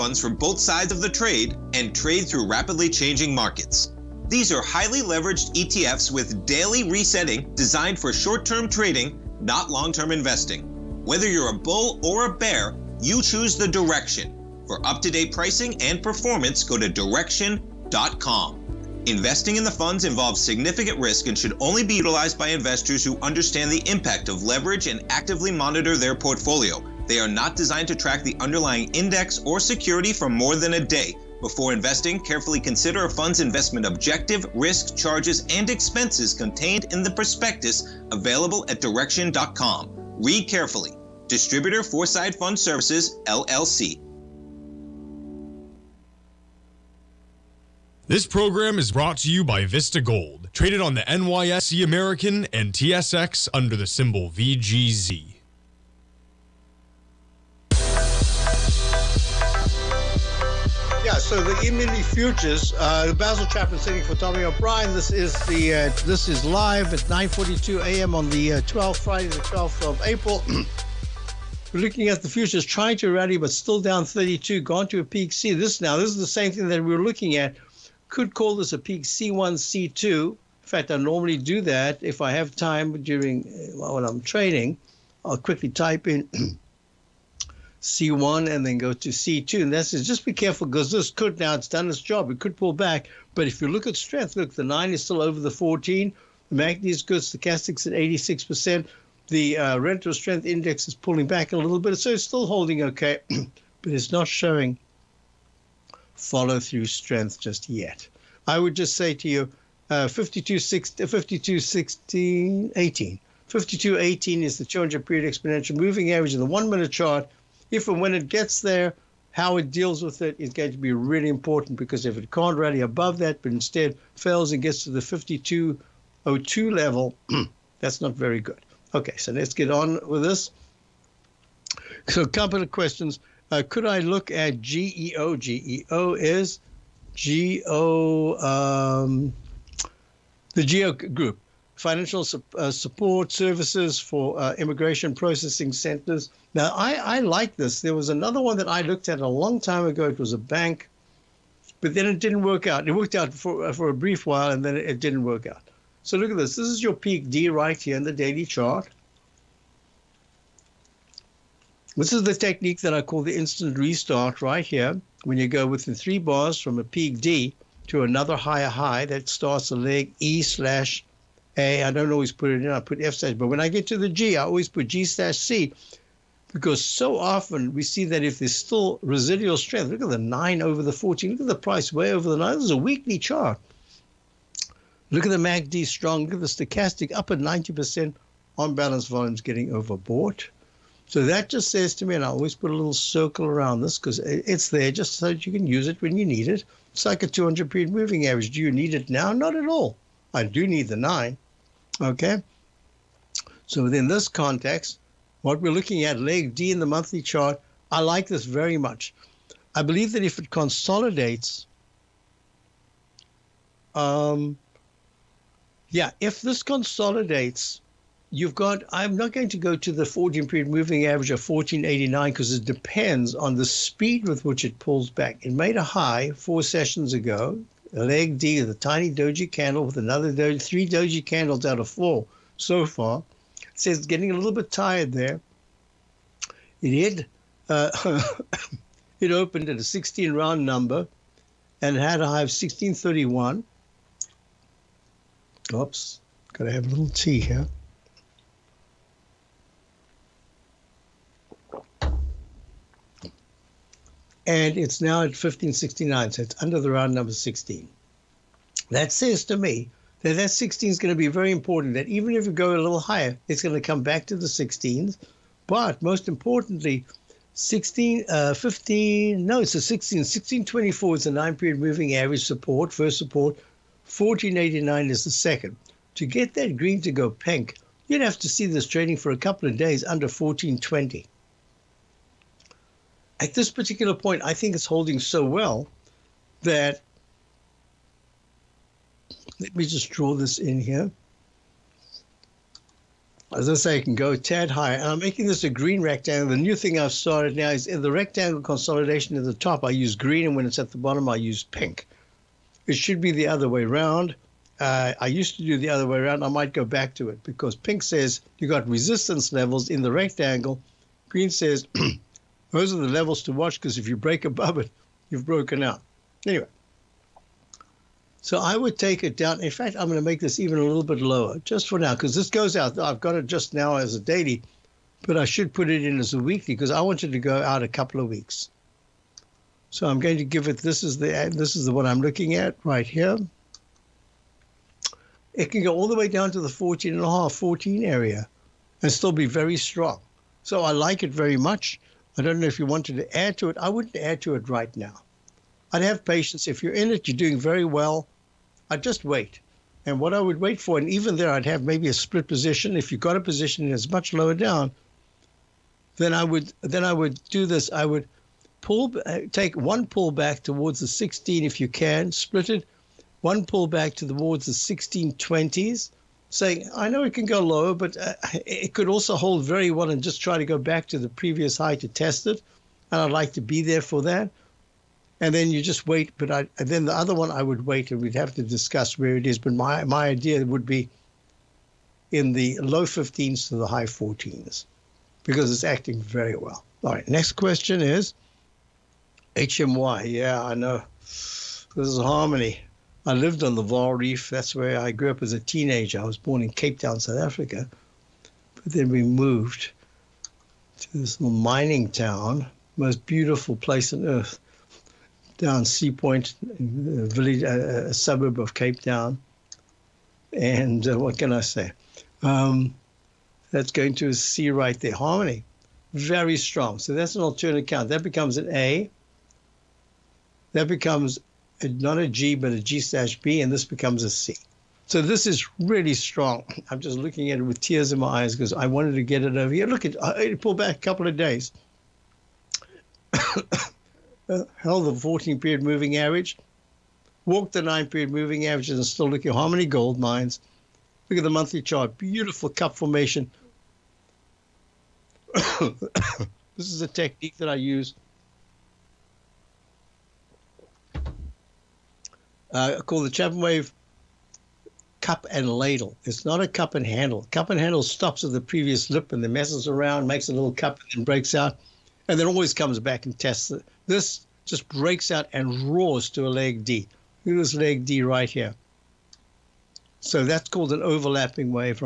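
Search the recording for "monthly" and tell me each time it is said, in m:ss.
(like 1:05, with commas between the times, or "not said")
3:26, 7:21.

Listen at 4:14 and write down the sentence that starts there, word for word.
and it's now at 1569, so it's under the round number 16.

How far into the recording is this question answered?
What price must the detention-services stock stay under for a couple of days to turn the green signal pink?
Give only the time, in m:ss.
4:40.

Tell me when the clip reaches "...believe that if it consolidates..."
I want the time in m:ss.
3:29.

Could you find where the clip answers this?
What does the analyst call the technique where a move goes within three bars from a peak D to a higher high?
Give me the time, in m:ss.
2:43.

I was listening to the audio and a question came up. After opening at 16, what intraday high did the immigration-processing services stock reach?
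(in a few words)
16.31.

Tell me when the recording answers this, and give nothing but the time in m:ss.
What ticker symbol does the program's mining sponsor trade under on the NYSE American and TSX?
0:54.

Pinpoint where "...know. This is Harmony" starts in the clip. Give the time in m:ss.
6:30.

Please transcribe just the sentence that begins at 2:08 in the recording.
Okay, so let's get on with this.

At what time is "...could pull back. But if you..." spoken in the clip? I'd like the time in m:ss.
1:32.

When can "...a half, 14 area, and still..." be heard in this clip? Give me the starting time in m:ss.
5:37.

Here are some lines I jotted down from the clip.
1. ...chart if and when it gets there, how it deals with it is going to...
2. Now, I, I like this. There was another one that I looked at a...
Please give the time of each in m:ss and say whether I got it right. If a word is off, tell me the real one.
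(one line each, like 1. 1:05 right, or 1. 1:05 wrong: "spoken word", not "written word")
1. 1:56 right
2. 2:26 right.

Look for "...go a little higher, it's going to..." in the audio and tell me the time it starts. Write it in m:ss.
4:22.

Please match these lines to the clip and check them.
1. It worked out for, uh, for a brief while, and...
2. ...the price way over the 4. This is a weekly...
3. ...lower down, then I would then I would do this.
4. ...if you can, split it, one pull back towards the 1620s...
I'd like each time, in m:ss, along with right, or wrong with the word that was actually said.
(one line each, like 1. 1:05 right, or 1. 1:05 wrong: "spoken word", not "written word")
1. 2:32 right
2. 3:01 wrong: "9", not "4"
3. 5:54 right
4. 6:01 right.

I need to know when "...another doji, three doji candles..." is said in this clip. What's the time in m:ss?
3:49.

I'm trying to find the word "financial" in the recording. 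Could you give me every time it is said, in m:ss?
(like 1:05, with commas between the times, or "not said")
2:21.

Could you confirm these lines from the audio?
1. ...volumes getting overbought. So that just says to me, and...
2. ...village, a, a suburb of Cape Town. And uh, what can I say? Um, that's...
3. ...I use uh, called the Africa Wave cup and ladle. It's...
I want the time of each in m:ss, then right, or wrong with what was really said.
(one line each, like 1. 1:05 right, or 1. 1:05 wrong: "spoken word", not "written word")
1. 3:09 right
2. 6:47 right
3. 7:27 wrong: "Chapman", not "Africa".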